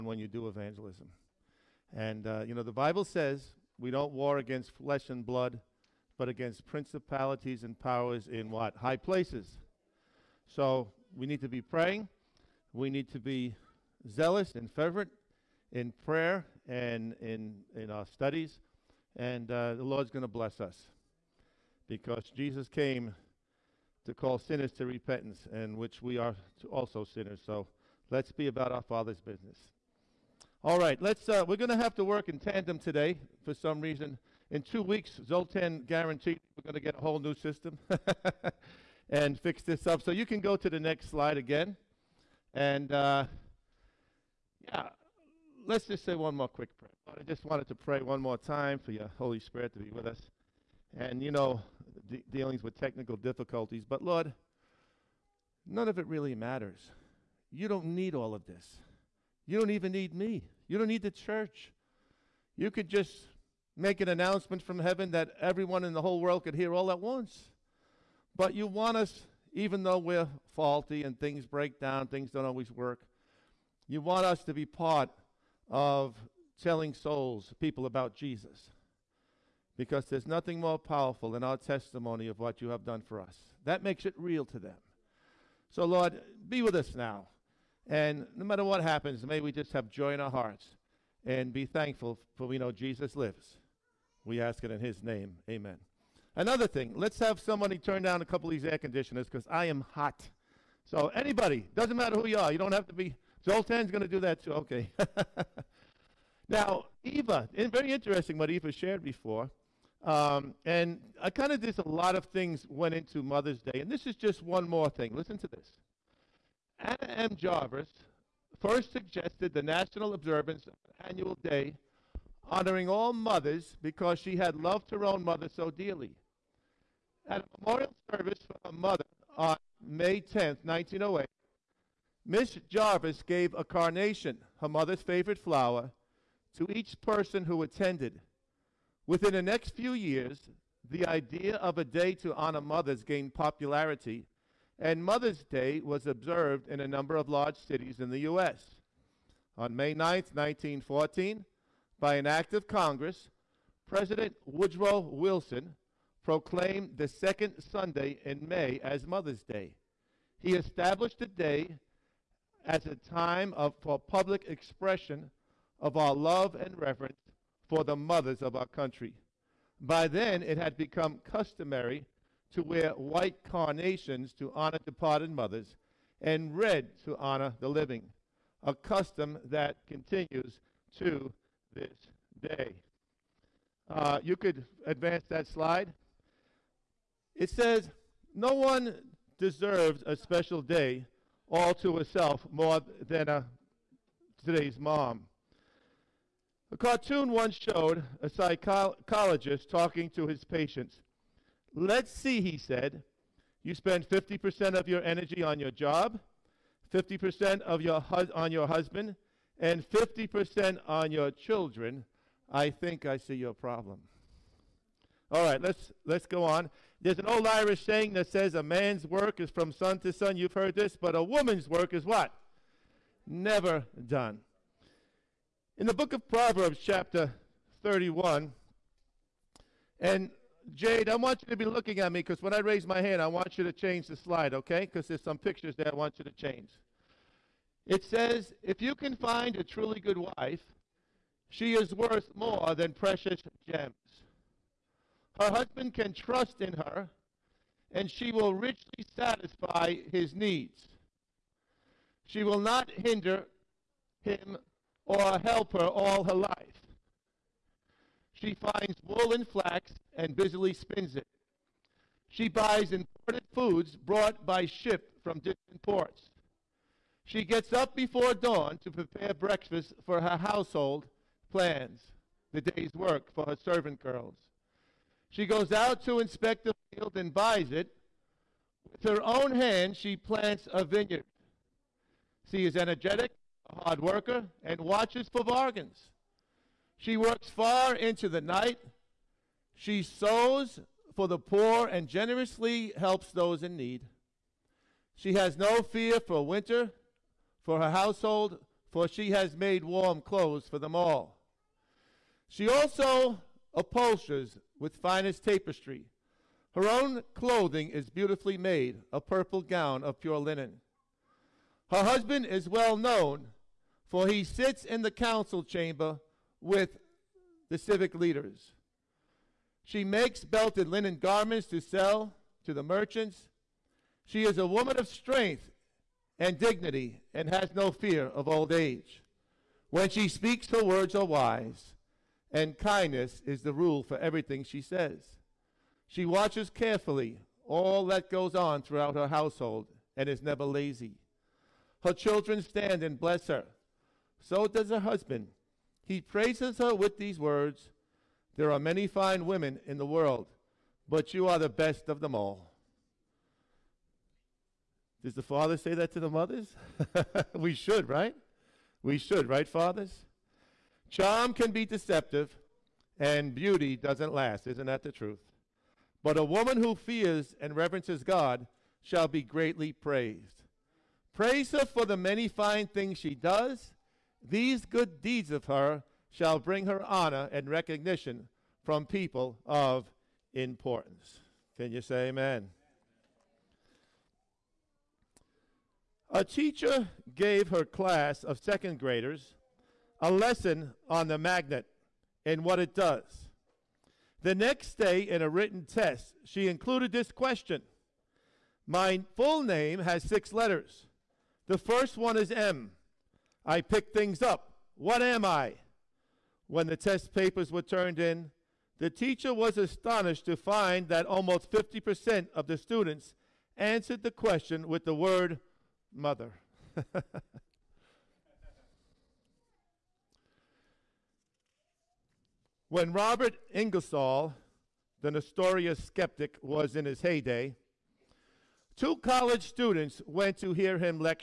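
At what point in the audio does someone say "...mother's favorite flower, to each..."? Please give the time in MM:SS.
02:14.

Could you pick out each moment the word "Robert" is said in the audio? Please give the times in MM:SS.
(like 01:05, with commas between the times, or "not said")
07:03.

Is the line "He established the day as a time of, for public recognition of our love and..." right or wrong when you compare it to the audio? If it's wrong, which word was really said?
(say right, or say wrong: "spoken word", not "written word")
wrong: "expression", not "recognition".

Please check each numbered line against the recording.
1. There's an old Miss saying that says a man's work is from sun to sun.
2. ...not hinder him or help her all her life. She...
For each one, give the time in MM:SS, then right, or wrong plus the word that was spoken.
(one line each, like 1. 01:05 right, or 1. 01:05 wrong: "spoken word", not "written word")
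1. 03:37 wrong: "Irish", not "Miss"
2. 04:12 right.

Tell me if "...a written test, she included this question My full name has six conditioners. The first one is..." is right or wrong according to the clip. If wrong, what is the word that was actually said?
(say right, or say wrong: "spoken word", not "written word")
wrong: "letters", not "conditioners".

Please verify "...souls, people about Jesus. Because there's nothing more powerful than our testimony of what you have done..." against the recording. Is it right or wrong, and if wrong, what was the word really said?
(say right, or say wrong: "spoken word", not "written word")
right.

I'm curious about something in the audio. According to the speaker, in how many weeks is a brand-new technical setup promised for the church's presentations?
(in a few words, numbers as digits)
2.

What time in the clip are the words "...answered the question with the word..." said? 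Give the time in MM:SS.
06:53.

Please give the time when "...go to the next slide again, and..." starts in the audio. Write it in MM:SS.
00:40.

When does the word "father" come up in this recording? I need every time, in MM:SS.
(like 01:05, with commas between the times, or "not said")
00:28, 05:55, 05:59.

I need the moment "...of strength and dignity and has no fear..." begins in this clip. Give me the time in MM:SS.
05:24.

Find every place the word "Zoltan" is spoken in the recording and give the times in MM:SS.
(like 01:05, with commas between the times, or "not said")
00:35, 01:43.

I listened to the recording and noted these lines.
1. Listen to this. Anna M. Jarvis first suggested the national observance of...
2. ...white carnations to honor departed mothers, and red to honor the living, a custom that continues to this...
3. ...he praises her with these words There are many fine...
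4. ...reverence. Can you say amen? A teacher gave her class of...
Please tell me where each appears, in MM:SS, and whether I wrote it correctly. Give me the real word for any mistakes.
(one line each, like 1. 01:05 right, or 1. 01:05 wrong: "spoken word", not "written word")
1. 01:55 right
2. 02:52 right
3. 05:46 right
4. 06:20 wrong: "importance", not "reverence".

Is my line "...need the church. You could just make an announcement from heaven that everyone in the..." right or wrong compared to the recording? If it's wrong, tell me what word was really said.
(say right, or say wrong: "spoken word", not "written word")
right.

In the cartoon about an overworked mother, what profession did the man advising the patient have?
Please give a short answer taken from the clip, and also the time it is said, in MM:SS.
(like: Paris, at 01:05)
psychologist, at 03:18.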